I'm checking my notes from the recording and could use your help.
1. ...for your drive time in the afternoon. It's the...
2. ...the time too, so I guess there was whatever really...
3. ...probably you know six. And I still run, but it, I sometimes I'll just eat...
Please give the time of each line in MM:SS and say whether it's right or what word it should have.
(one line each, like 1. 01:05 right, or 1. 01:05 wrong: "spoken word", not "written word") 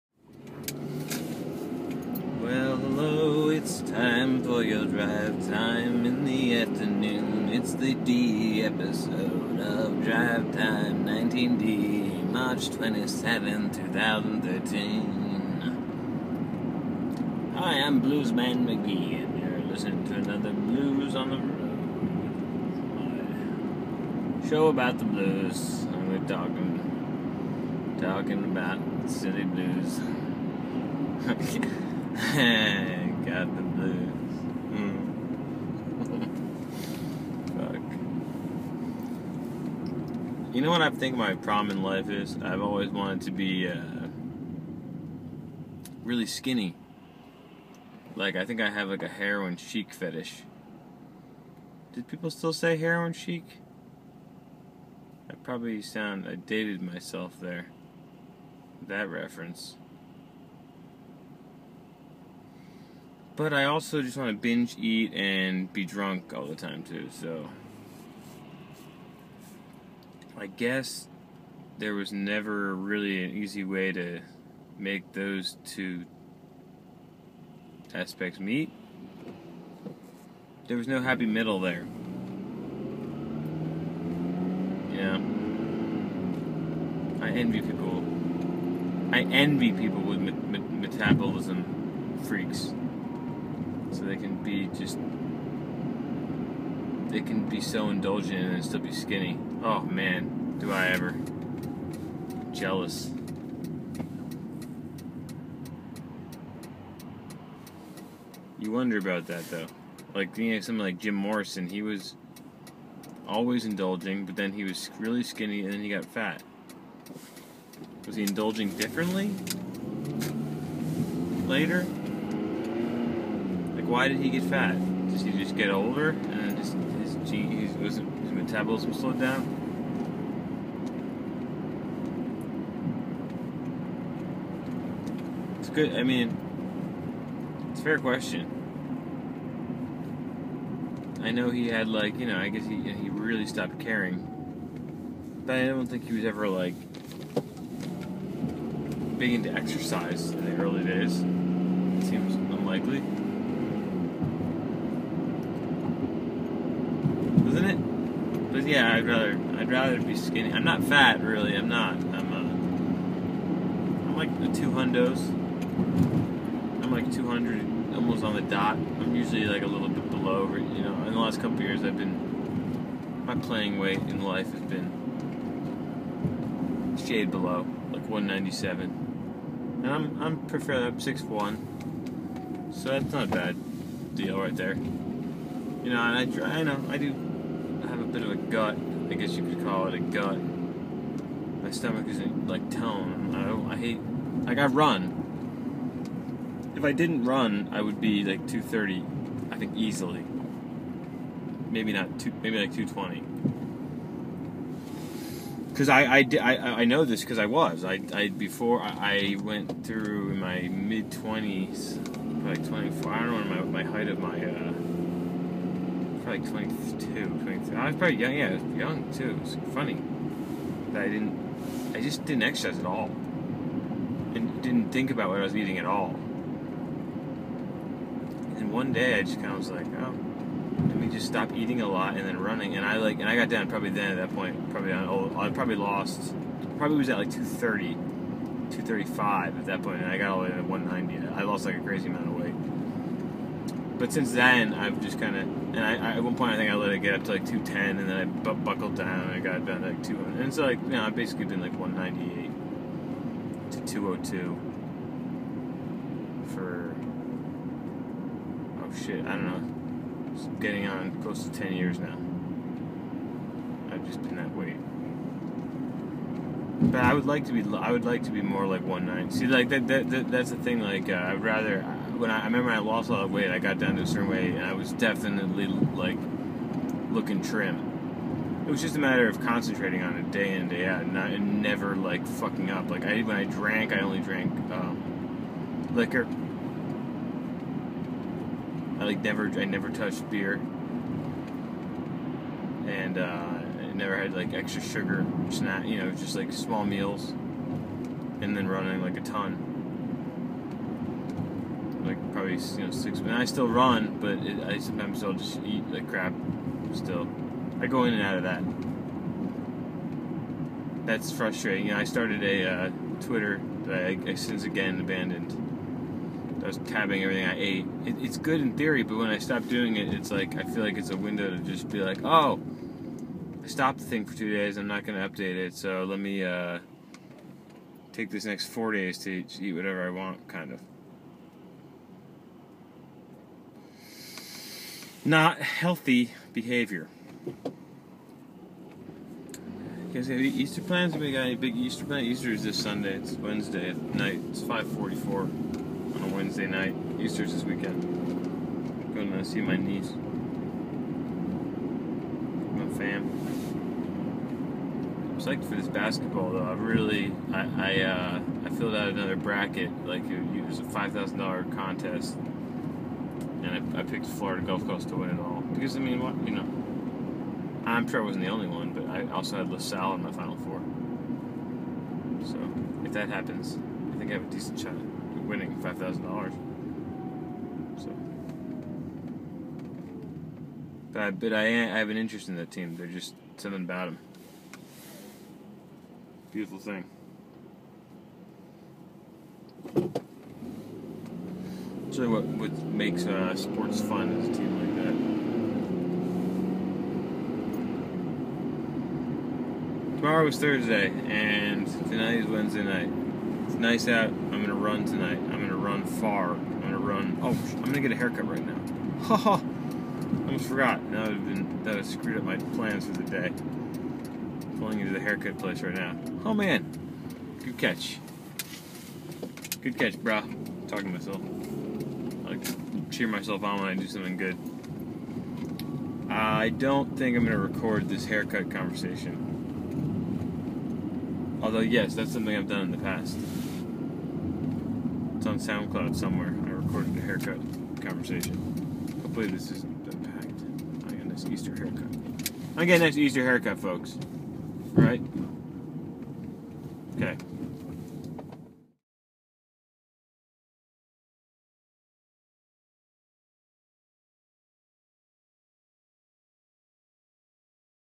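1. 00:04 right
2. 01:06 wrong: "never", not "whatever"
3. 05:02 right.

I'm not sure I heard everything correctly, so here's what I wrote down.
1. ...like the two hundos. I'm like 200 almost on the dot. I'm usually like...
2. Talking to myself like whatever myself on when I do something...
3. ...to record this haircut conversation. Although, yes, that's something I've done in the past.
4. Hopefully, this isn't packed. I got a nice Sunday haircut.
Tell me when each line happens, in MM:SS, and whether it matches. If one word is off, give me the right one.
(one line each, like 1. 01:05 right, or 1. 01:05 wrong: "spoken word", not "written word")
1. 02:44 right
2. 07:00 wrong: "cheer", not "whatever"
3. 07:07 right
4. 07:19 wrong: "Easter", not "Sunday".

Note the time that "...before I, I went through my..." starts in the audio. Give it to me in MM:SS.
03:28.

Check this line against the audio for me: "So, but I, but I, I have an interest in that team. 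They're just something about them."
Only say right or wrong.
right.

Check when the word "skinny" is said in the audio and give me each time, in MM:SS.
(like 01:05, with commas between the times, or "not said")
00:46, 01:38, 01:55, 02:40.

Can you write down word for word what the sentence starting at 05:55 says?
I'm psyched for this basketball though.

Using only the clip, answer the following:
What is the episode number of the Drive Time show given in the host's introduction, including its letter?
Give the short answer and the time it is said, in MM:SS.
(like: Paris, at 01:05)
19D, at 00:11.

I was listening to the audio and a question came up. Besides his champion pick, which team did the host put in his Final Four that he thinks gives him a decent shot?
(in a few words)
LaSalle.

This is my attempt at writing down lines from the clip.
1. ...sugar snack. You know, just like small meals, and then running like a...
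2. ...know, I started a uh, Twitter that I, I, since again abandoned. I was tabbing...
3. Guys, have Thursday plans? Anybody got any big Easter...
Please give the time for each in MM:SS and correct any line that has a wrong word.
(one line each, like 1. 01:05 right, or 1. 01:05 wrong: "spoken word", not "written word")
1. 04:54 right
2. 05:11 right
3. 05:40 wrong: "Easter", not "Thursday".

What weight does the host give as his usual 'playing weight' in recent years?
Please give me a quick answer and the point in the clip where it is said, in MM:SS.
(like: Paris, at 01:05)
197, at 02:58.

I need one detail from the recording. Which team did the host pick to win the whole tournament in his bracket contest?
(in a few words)
Florida Gulf Coast.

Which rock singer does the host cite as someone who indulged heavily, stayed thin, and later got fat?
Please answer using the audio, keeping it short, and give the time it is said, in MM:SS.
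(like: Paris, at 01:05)
Jim Morrison, at 01:50.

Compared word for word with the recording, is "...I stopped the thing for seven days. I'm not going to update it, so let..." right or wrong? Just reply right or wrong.
wrong.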